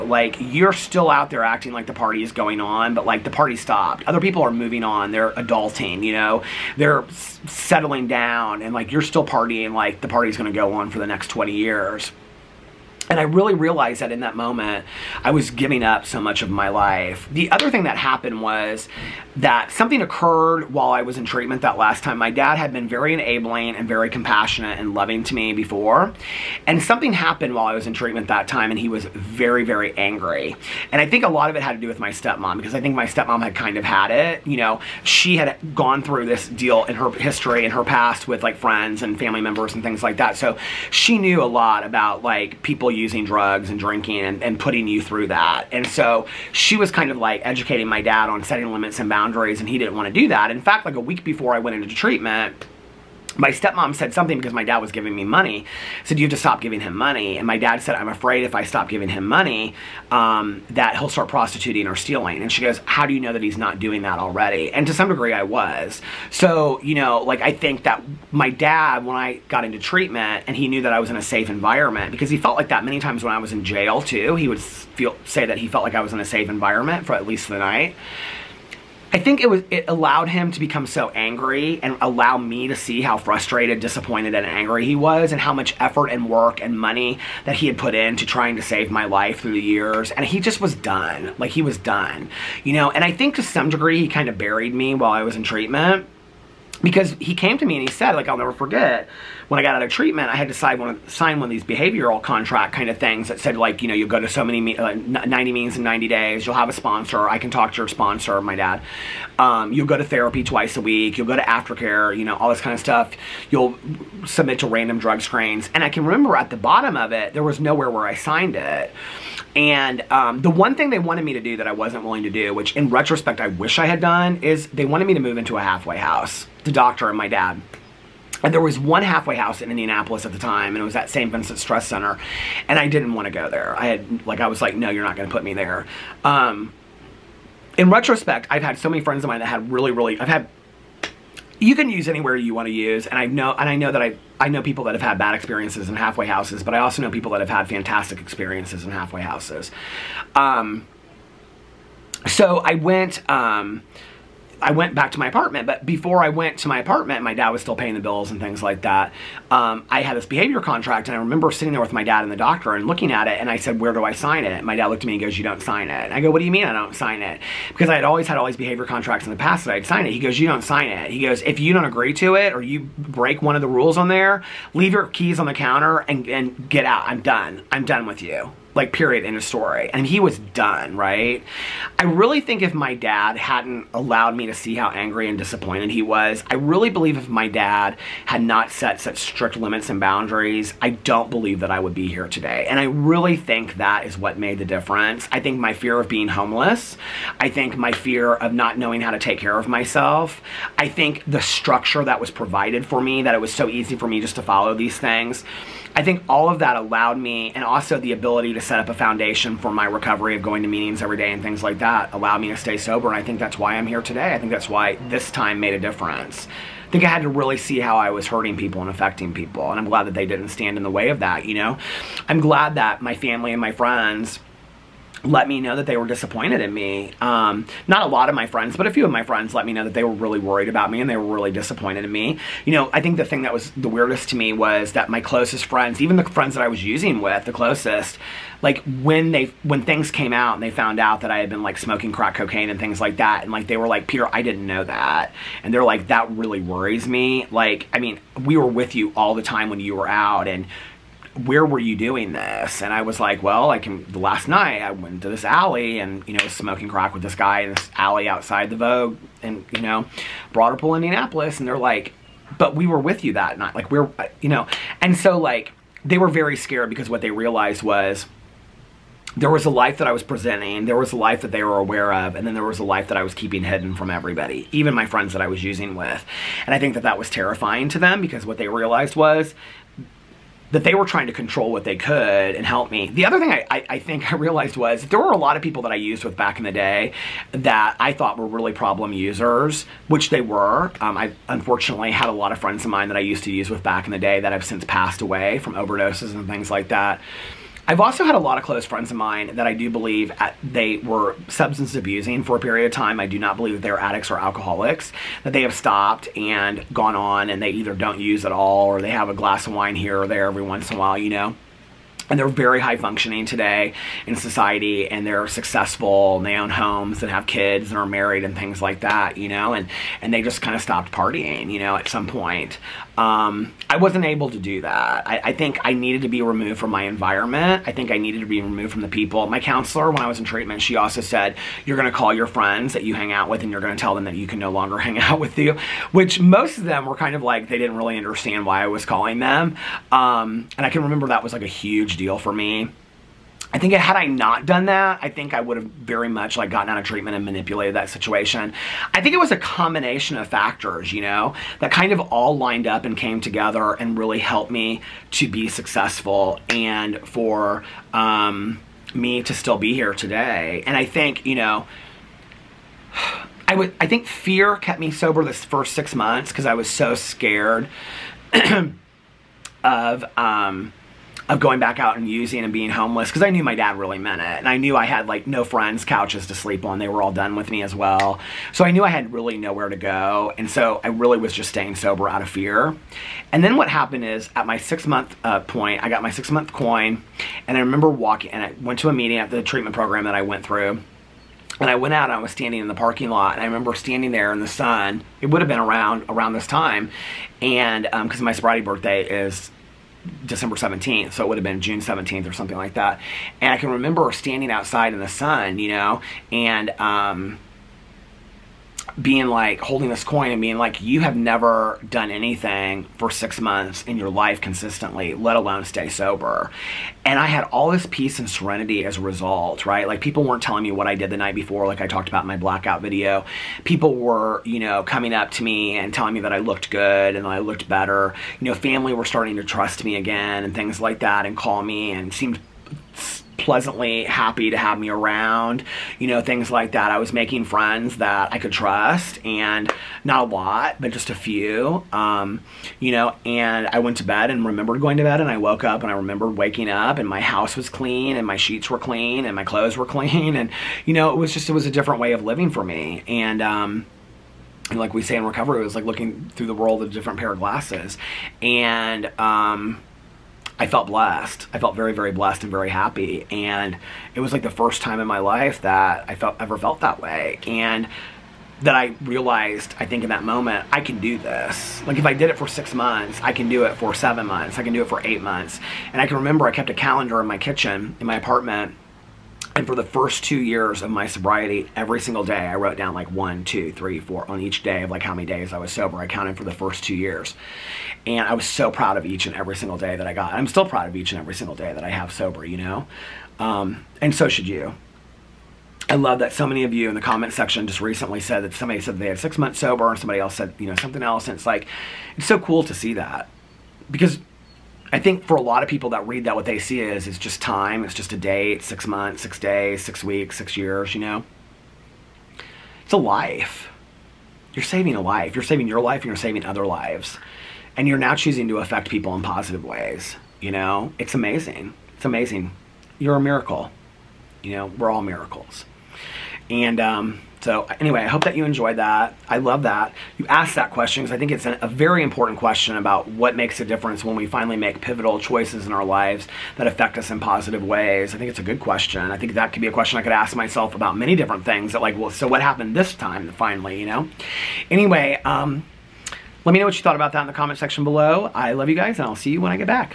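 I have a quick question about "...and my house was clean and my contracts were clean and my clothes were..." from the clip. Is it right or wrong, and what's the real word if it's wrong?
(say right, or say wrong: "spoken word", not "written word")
wrong: "sheets", not "contracts".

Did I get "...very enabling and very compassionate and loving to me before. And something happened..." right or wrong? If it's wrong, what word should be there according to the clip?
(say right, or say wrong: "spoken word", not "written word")
right.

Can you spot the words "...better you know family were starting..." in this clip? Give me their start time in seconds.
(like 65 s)
427 s.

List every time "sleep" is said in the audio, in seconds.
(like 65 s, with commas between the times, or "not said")
376 s.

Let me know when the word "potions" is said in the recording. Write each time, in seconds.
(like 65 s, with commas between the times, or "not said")
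not said.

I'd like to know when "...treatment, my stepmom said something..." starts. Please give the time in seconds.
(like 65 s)
51 s.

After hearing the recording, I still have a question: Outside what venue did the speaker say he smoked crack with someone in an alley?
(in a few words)
The Vogue.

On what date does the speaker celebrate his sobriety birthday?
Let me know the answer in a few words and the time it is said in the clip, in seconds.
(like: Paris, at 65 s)
December 17th, at 400 s.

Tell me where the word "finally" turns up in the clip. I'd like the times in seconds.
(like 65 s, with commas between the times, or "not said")
534 s, 543 s.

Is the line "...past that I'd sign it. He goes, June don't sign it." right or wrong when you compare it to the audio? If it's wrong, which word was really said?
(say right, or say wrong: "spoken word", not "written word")
wrong: "You", not "June".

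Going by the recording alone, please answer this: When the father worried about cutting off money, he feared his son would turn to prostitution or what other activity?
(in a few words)
Stealing.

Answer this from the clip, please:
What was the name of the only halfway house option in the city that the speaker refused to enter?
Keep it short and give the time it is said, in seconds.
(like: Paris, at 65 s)
St. Vincent Stress Center, at 131 s.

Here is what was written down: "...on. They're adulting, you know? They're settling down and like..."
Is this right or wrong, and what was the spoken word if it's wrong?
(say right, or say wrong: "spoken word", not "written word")
right.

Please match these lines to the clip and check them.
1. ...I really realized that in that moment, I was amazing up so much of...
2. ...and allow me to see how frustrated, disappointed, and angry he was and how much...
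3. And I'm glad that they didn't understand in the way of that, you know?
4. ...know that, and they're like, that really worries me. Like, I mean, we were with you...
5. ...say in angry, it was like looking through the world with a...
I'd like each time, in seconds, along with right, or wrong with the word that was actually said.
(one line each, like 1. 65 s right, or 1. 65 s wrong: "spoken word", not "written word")
1. 13 s wrong: "giving", not "amazing"
2. 81 s right
3. 219 s wrong: "stand", not "understand"
4. 244 s right
5. 455 s wrong: "recovery", not "angry".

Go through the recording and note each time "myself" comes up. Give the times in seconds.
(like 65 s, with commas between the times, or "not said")
199 s, 540 s.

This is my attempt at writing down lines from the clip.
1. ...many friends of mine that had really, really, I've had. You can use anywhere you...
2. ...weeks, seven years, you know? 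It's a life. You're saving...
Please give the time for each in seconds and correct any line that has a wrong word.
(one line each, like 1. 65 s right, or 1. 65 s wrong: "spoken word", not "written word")
1. 138 s right
2. 510 s wrong: "six", not "seven".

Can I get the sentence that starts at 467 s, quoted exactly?
And that I realized, I think in that moment, I can do this.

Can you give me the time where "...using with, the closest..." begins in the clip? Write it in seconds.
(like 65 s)
236 s.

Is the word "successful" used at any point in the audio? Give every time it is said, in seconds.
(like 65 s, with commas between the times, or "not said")
315 s, 355 s.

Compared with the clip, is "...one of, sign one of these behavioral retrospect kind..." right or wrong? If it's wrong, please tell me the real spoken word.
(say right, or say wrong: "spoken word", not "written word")
wrong: "contract", not "retrospect".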